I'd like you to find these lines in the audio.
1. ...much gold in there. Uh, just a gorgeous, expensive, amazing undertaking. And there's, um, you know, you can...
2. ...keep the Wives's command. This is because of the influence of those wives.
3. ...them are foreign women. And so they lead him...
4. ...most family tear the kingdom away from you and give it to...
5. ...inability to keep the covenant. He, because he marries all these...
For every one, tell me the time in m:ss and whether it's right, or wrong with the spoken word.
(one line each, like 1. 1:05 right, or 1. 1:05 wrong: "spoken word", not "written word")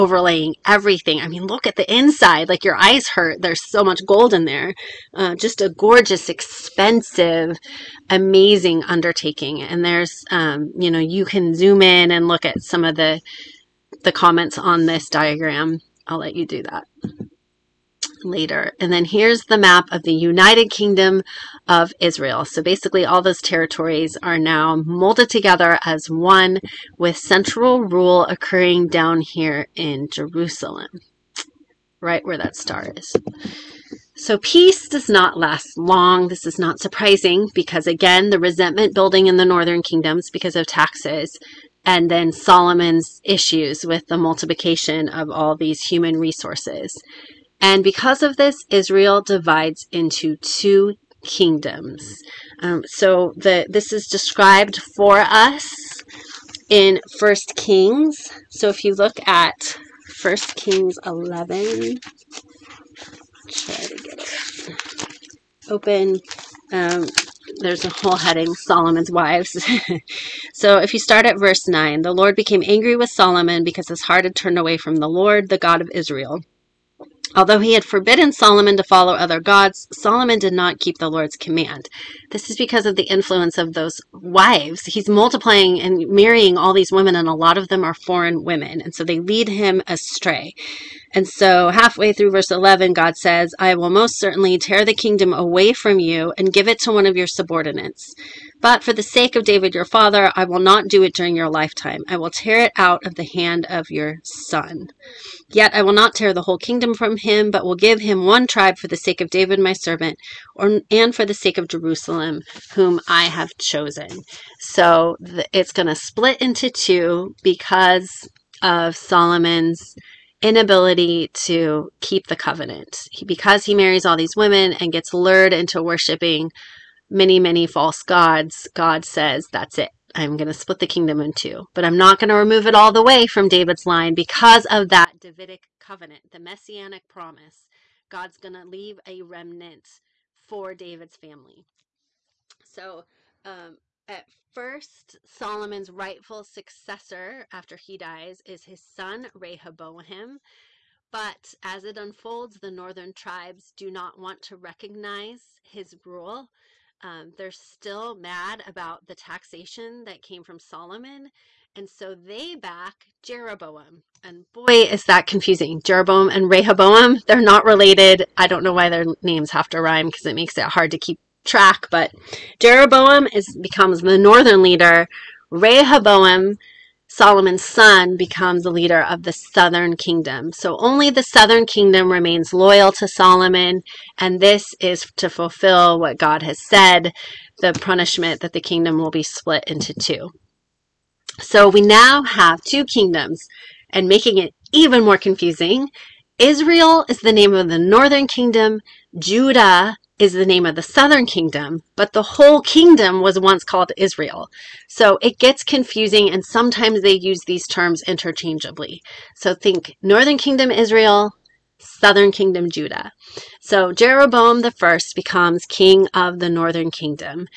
1. 0:03 right
2. 1:20 wrong: "Lord", not "Wives"
3. 1:27 right
4. 1:33 wrong: "certainly", not "family"
5. 2:00 right.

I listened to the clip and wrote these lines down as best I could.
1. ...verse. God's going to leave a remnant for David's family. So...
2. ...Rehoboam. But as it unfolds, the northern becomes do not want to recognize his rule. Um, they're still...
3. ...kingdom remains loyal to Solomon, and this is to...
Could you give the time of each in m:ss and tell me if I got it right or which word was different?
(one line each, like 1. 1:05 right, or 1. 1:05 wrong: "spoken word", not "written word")
1. 2:17 wrong: "promise", not "verse"
2. 2:29 wrong: "tribes", not "becomes"
3. 3:01 right.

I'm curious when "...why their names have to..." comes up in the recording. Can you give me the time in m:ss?
2:48.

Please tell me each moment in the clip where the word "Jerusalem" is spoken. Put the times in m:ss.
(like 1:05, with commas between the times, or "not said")
0:30, 1:51.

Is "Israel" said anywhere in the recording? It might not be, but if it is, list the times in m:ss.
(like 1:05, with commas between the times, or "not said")
0:21, 0:48, 1:15, 3:16, 3:23, 3:30.